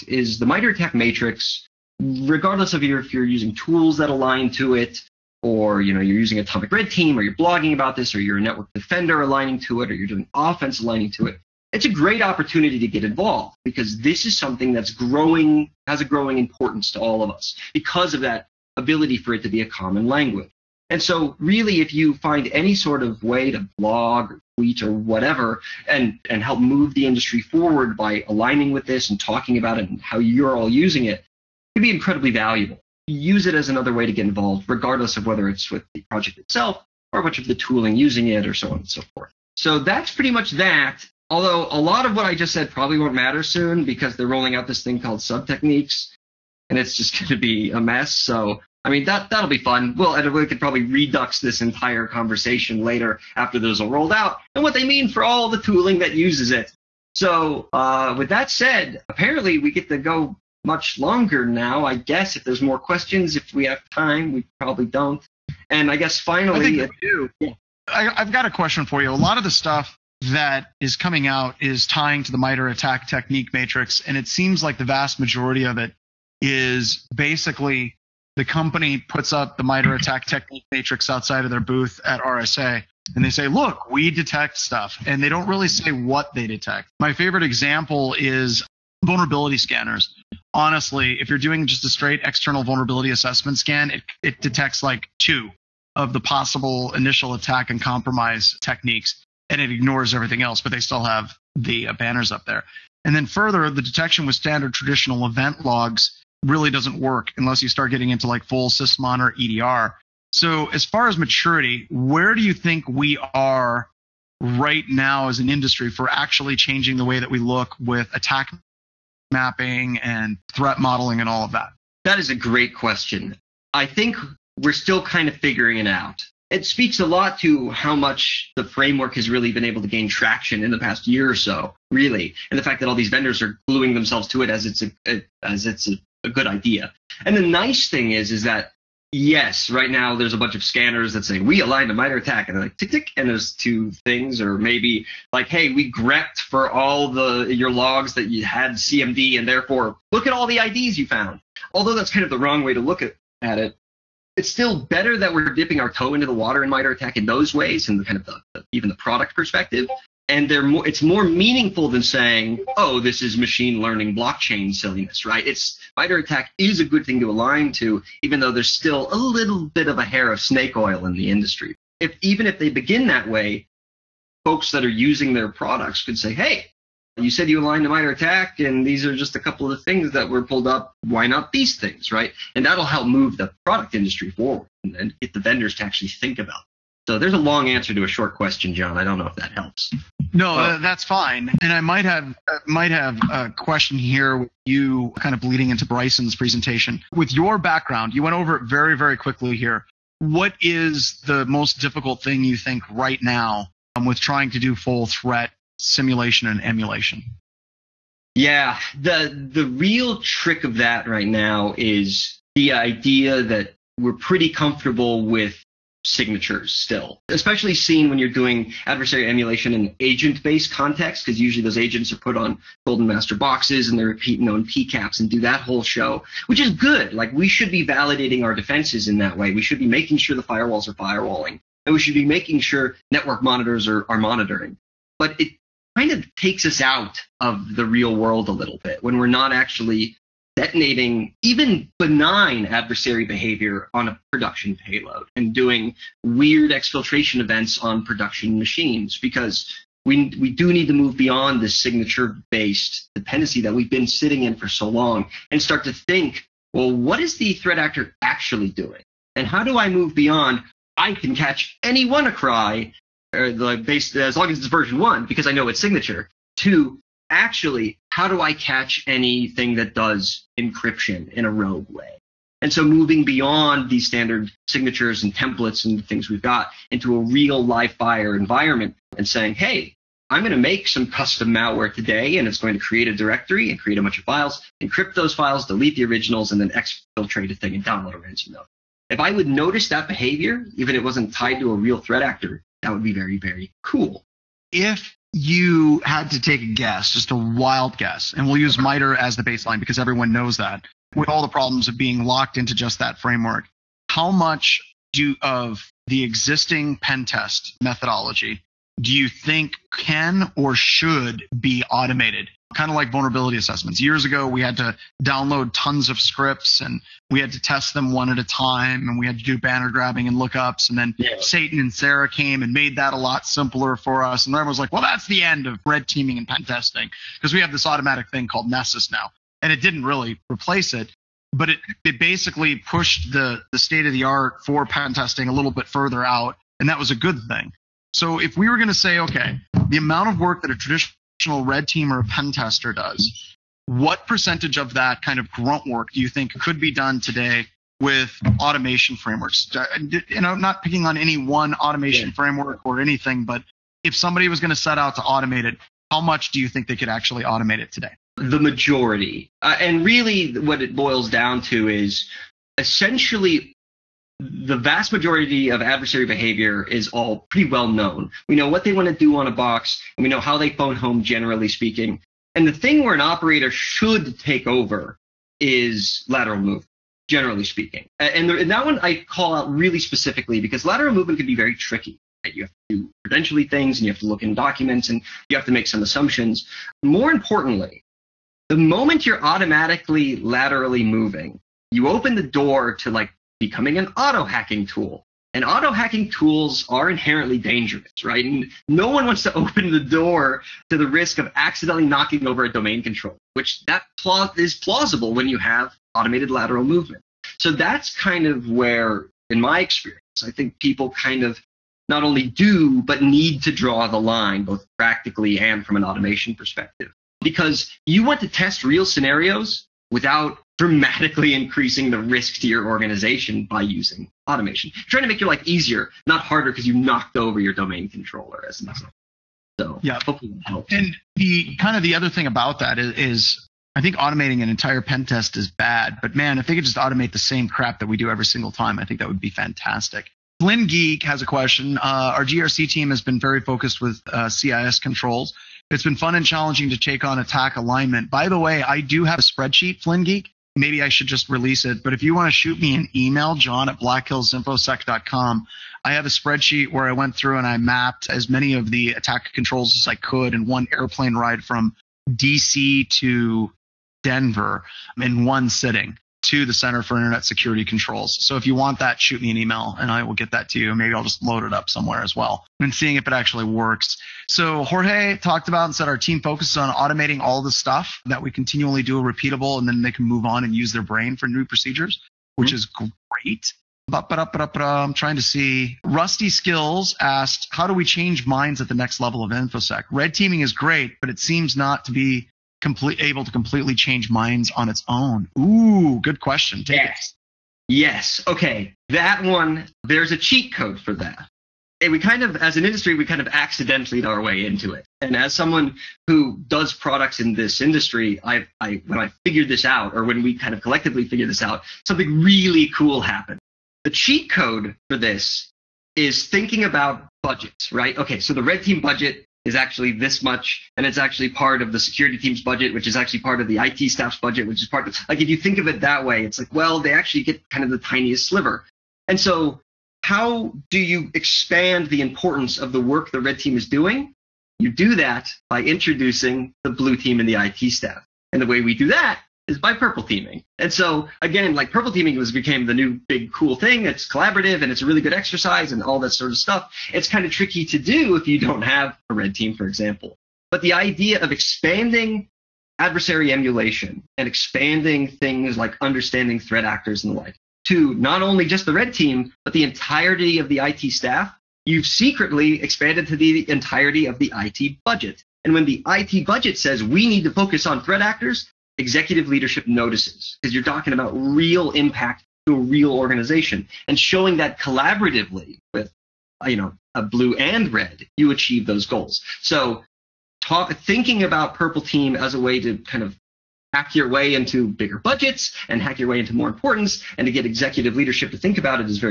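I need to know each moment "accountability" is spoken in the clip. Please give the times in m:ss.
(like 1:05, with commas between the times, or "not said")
not said.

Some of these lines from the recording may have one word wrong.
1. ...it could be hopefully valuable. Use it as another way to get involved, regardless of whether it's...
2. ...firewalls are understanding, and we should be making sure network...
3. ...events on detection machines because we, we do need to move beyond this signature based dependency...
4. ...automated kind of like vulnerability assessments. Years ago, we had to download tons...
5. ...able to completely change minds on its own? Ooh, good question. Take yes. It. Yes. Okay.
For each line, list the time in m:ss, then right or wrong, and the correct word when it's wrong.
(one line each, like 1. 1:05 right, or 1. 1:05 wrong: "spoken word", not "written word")
1. 0:31 wrong: "incredibly", not "hopefully"
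2. 3:50 wrong: "firewalling", not "understanding"
3. 4:07 wrong: "production", not "detection"
4. 5:11 right
5. 8:13 right.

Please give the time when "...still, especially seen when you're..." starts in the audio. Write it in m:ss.
3:36.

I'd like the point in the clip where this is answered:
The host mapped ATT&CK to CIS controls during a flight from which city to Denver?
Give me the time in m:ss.
7:42.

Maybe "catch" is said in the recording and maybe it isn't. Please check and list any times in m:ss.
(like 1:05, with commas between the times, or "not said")
4:21, 4:28.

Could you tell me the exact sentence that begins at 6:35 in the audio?
And auto hacking tools are inherently dangerous, right?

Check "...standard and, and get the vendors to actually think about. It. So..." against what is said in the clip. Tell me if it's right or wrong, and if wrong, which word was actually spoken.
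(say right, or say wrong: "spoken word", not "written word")
wrong: "forward", not "standard".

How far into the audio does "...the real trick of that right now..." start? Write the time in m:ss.
3:29.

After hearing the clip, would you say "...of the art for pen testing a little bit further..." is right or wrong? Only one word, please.
right.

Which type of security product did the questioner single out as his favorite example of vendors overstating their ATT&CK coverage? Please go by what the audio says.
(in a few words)
Vulnerability scanners.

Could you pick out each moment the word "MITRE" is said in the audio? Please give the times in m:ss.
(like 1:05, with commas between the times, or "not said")
0:00, 1:12, 1:19, 2:21, 2:36, 2:45, 2:57, 4:58.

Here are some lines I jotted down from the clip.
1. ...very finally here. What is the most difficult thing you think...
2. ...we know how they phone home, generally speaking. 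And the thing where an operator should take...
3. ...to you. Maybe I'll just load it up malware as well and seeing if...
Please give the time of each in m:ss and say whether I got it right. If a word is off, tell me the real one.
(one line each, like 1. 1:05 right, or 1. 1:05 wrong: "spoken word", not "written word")
1. 3:18 wrong: "quickly", not "finally"
2. 6:10 right
3. 7:50 wrong: "somewhere", not "malware".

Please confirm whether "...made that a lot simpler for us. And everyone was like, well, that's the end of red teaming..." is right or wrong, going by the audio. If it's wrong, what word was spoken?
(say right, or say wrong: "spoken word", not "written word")
right.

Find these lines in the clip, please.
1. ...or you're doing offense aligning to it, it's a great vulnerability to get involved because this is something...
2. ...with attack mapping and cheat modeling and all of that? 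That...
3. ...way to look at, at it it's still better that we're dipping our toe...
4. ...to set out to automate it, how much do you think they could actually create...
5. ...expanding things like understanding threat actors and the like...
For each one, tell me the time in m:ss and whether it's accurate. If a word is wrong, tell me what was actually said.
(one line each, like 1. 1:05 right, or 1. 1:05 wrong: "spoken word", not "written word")
1. 0:09 wrong: "opportunity", not "vulnerability"
2. 1:57 wrong: "threat", not "cheat"
3. 2:32 right
4. 5:54 wrong: "automate", not "create"
5. 9:14 right.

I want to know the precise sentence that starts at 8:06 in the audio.
Rusty Skills asked, How do we change minds at the next level of InfoSec?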